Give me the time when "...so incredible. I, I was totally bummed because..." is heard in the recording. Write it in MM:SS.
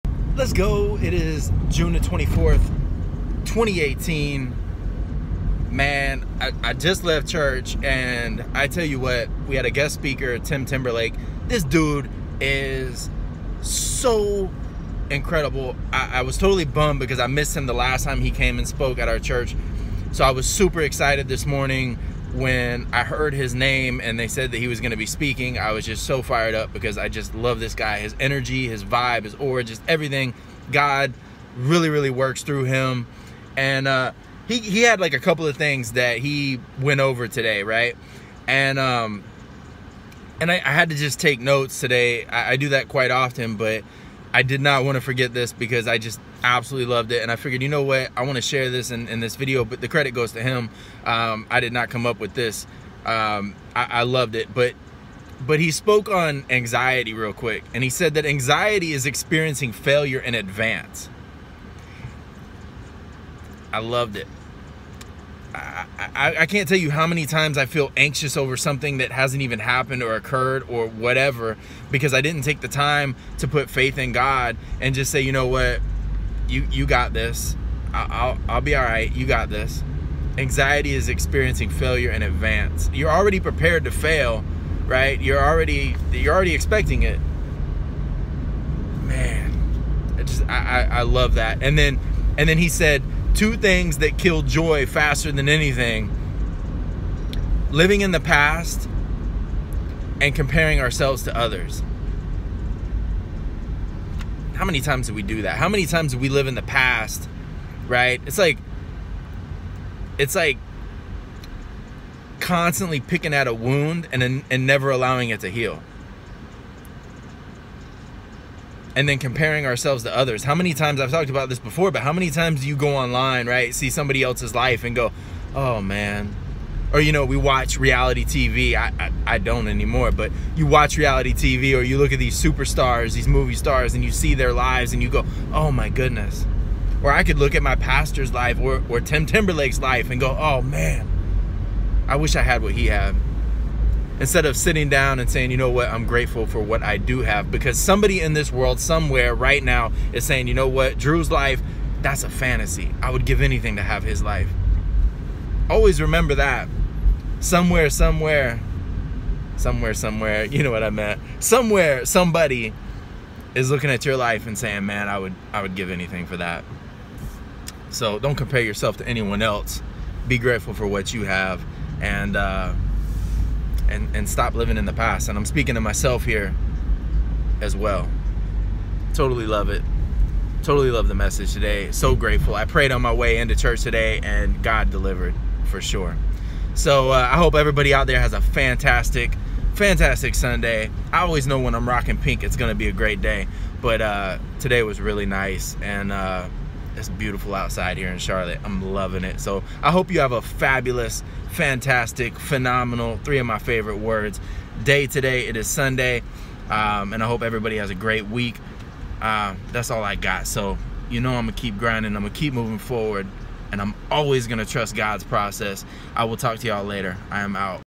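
00:13.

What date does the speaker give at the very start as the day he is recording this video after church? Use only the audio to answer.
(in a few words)
June 24, 2018.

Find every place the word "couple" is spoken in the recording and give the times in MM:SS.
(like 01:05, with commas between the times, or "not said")
00:35.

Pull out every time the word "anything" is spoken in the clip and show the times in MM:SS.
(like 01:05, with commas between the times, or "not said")
01:35, 02:33, 02:45.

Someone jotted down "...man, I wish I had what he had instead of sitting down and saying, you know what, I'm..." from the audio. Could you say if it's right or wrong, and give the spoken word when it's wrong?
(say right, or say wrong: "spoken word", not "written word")
right.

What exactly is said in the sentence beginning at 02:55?
And I'm speaking to myself here as well.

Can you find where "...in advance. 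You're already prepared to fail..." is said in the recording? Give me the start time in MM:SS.
01:22.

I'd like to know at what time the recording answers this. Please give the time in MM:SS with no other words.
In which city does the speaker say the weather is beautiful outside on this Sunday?
03:18.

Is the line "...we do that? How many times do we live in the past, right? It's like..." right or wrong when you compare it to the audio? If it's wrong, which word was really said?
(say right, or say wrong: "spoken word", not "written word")
right.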